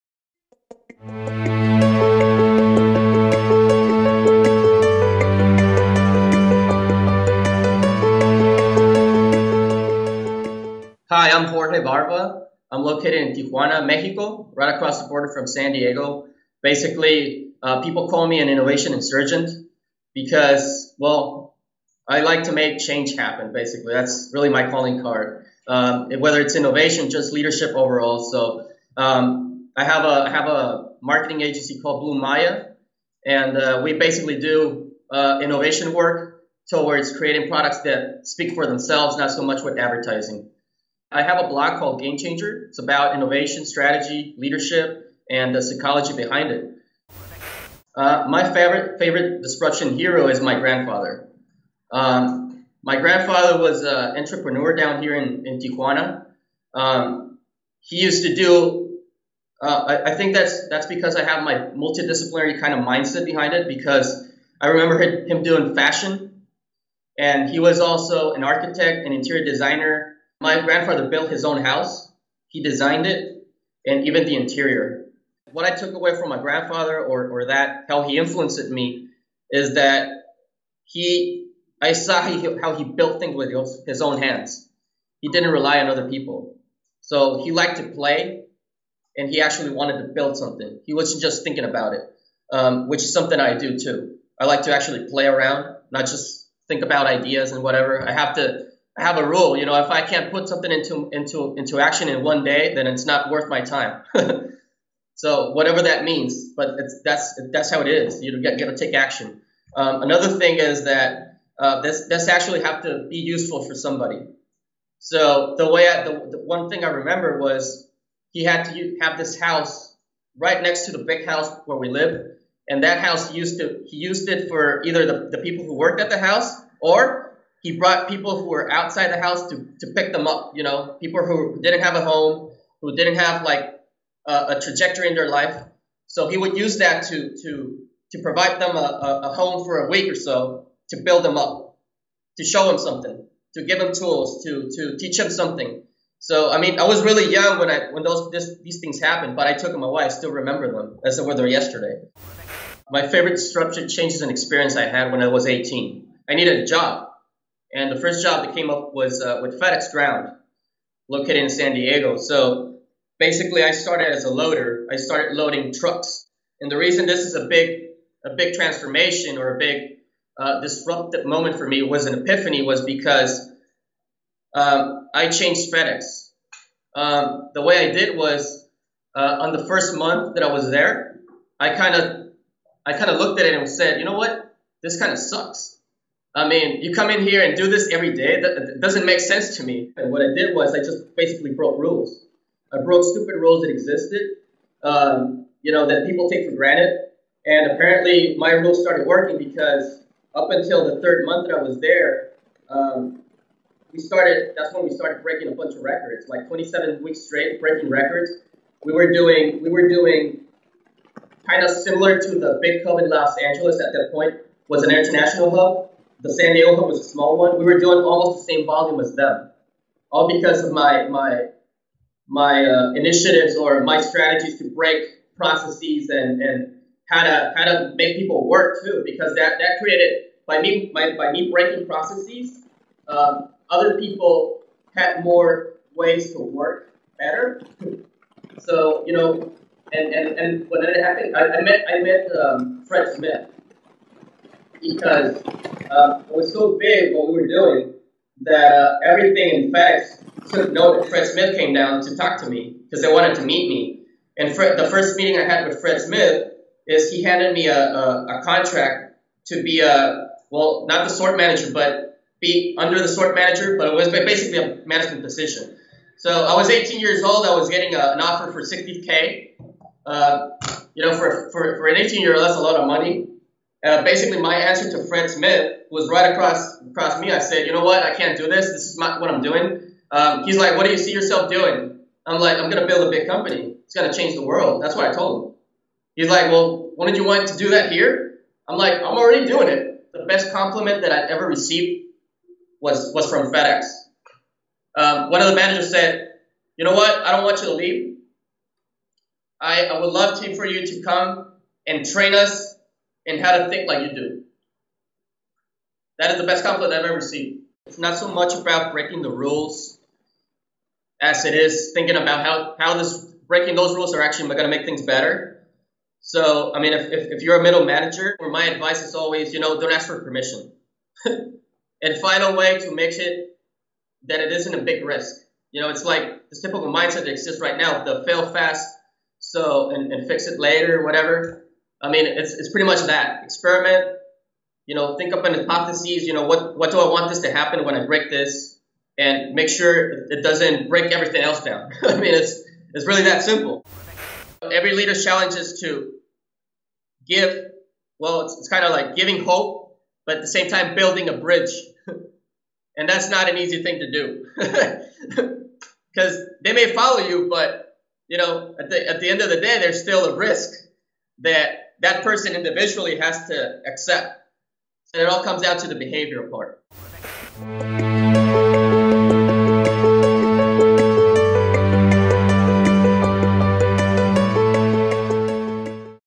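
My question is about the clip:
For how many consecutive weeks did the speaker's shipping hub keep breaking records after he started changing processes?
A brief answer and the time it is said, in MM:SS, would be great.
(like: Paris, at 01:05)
27, at 03:26.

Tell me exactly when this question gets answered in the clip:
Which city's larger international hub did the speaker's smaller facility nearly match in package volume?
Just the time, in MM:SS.
03:33.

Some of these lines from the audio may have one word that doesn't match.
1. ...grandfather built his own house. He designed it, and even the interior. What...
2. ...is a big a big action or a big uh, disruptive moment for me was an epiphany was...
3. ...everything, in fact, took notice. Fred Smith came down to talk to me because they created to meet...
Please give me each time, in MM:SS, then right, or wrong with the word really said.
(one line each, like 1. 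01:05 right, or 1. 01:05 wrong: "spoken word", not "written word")
1. 01:10 right
2. 02:47 wrong: "transformation", not "action"
3. 04:09 wrong: "wanted", not "created".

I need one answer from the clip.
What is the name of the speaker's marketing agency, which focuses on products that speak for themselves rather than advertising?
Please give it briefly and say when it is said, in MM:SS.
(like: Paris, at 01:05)
Blu Maya, at 00:32.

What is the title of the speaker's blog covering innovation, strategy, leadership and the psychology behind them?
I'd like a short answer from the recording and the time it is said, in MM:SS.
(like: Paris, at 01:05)
Game Changer, at 00:42.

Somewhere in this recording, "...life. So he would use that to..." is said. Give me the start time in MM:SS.
02:15.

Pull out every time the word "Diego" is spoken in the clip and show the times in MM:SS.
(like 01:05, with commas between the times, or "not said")
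00:15, 02:41, 03:36.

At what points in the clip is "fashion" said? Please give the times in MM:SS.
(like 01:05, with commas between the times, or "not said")
01:05.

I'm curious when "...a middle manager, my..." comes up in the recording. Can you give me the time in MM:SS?
05:17.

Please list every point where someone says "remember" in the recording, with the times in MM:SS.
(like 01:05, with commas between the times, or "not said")
01:04, 01:56, 02:30.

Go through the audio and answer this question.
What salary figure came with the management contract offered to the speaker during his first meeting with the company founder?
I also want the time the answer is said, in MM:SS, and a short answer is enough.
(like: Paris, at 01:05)
60k, at 04:28.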